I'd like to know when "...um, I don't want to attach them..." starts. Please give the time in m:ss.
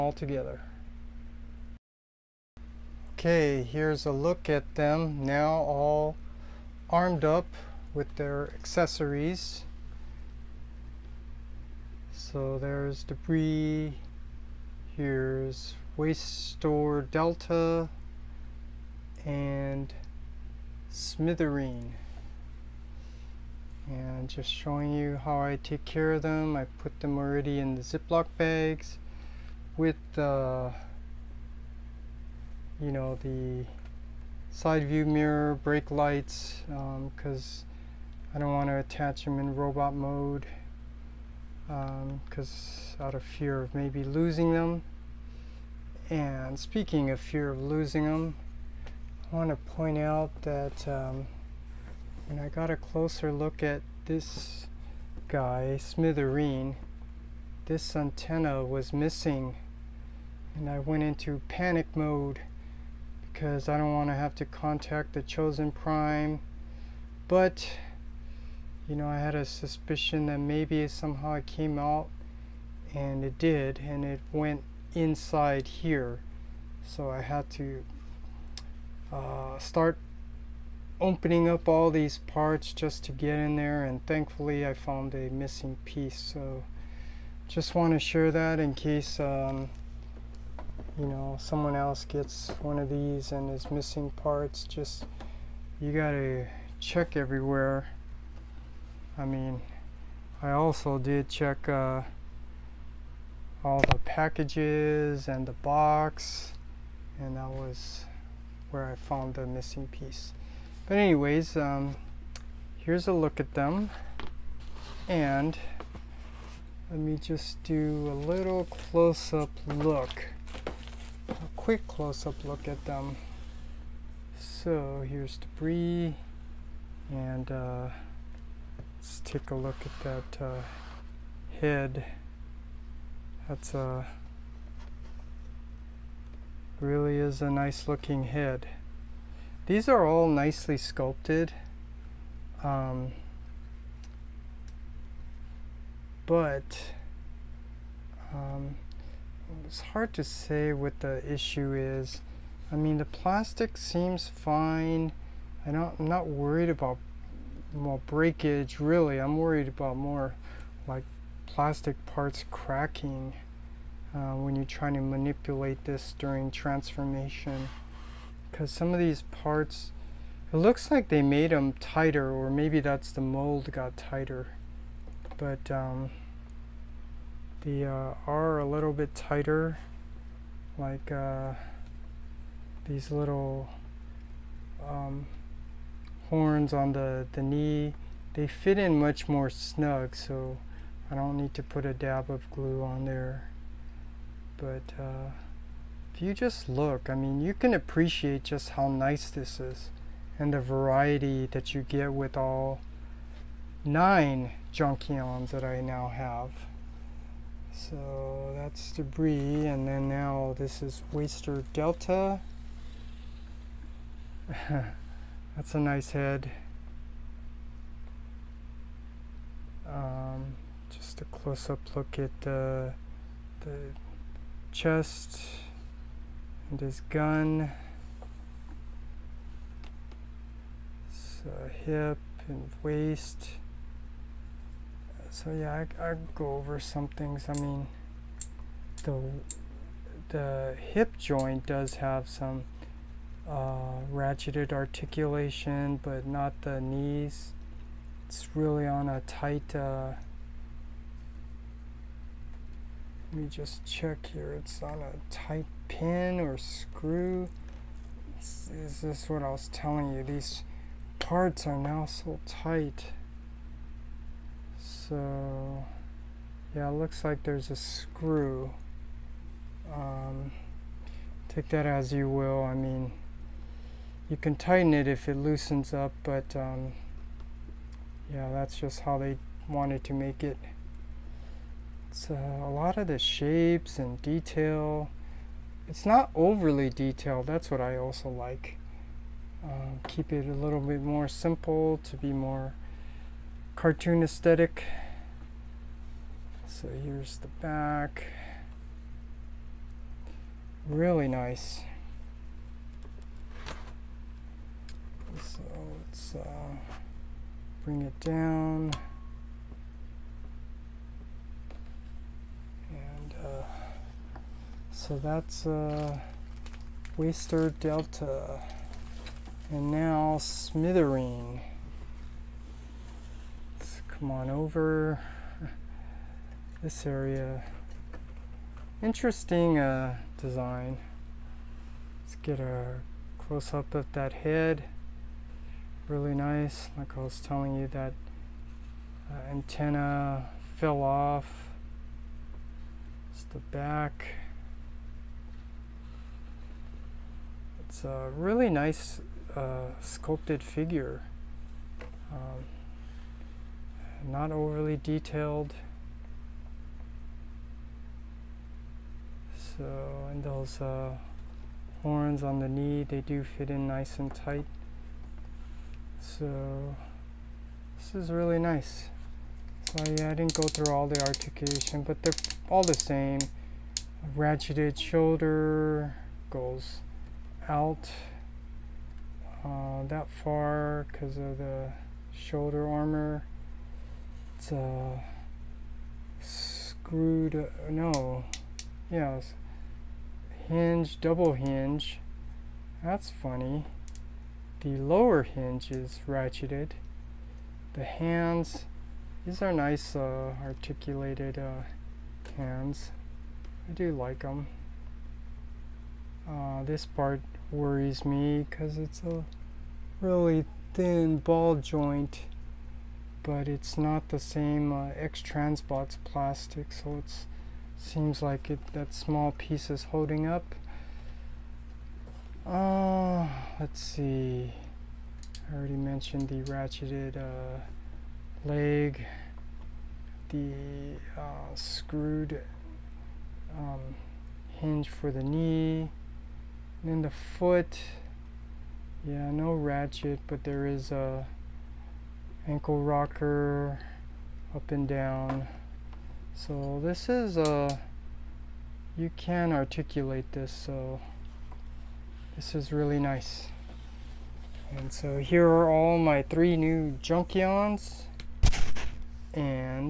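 0:38.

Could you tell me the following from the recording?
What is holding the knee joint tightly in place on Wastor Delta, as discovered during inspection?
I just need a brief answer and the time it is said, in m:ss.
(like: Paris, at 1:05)
a screw, at 4:27.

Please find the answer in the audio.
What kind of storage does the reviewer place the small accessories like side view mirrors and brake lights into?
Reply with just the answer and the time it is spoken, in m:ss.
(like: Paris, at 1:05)
Ziploc bags, at 0:27.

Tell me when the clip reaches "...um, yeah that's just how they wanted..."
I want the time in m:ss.
4:36.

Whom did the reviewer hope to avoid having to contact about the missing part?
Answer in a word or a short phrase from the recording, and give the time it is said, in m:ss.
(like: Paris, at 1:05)
the chosen prime, at 1:05.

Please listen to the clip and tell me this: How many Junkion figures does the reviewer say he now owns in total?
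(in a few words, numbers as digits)
9.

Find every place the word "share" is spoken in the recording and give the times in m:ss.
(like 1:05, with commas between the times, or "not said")
1:27.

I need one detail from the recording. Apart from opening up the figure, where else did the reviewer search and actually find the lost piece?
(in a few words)
the box.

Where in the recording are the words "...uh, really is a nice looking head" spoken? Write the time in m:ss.
2:13.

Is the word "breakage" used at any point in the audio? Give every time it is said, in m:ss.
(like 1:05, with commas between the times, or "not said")
2:38.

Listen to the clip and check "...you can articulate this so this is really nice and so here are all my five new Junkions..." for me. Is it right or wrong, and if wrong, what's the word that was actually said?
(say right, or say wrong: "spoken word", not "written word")
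wrong: "three", not "five".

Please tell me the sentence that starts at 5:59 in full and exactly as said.
So, and those uh, horns on the knee, they do fit in nice and tight.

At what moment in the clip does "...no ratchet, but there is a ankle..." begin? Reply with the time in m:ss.
7:19.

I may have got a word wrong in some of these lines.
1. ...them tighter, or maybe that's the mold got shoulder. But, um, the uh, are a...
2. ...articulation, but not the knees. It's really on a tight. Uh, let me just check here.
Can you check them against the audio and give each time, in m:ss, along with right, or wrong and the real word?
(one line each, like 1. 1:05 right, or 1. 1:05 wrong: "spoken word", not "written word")
1. 2:51 wrong: "tighter", not "shoulder"
2. 4:04 right.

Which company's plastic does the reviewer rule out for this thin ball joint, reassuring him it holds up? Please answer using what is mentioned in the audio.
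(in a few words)
X-Transbots.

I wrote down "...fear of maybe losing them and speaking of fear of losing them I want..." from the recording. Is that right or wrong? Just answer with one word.
right.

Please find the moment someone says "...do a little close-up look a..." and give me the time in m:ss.
1:57.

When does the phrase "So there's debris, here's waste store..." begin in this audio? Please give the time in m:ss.
0:12.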